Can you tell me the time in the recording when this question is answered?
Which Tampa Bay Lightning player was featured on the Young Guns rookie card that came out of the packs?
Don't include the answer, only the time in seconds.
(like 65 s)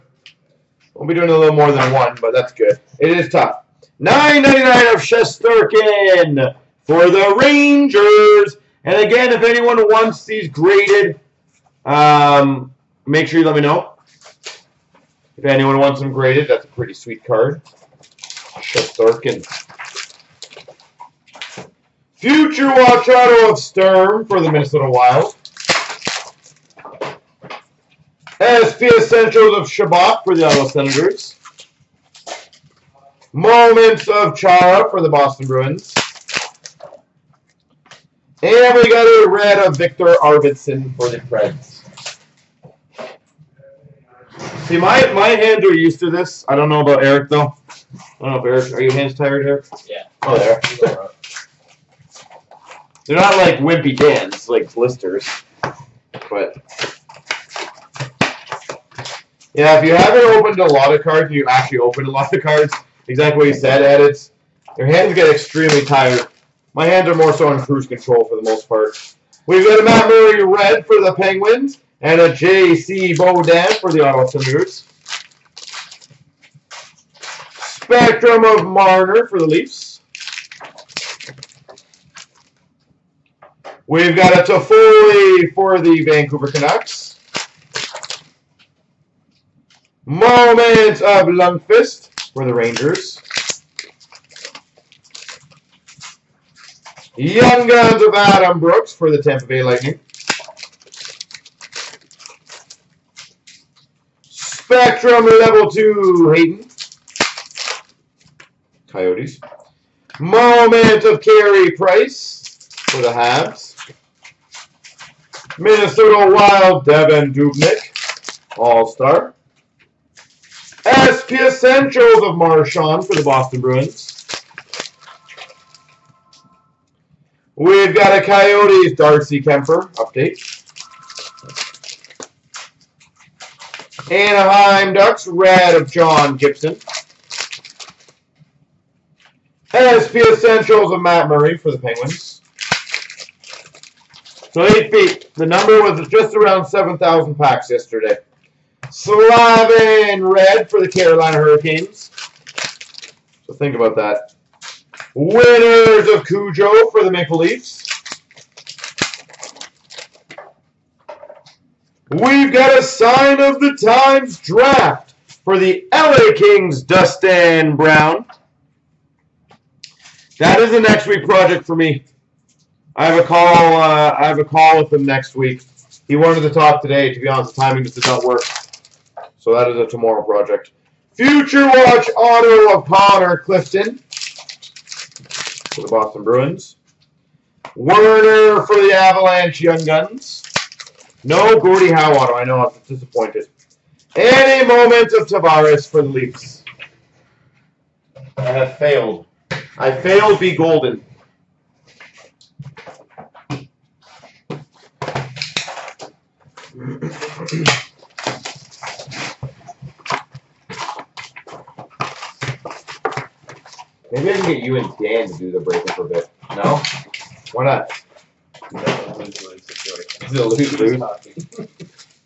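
98 s.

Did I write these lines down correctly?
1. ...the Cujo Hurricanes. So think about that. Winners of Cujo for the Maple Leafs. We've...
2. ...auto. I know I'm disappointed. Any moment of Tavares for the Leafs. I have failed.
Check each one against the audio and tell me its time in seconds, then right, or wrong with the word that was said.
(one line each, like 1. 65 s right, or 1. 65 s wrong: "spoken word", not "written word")
1. 150 s wrong: "Carolina", not "Cujo"
2. 192 s right.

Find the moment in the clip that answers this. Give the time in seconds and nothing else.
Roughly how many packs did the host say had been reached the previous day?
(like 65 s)
146 s.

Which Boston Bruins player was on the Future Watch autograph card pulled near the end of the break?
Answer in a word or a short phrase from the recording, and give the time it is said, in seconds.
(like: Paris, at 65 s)
Connor Clifton, at 182 s.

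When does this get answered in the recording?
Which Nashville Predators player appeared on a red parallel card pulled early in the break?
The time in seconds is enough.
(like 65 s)
39 s.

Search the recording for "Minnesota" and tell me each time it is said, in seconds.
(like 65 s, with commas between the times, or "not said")
24 s, 115 s.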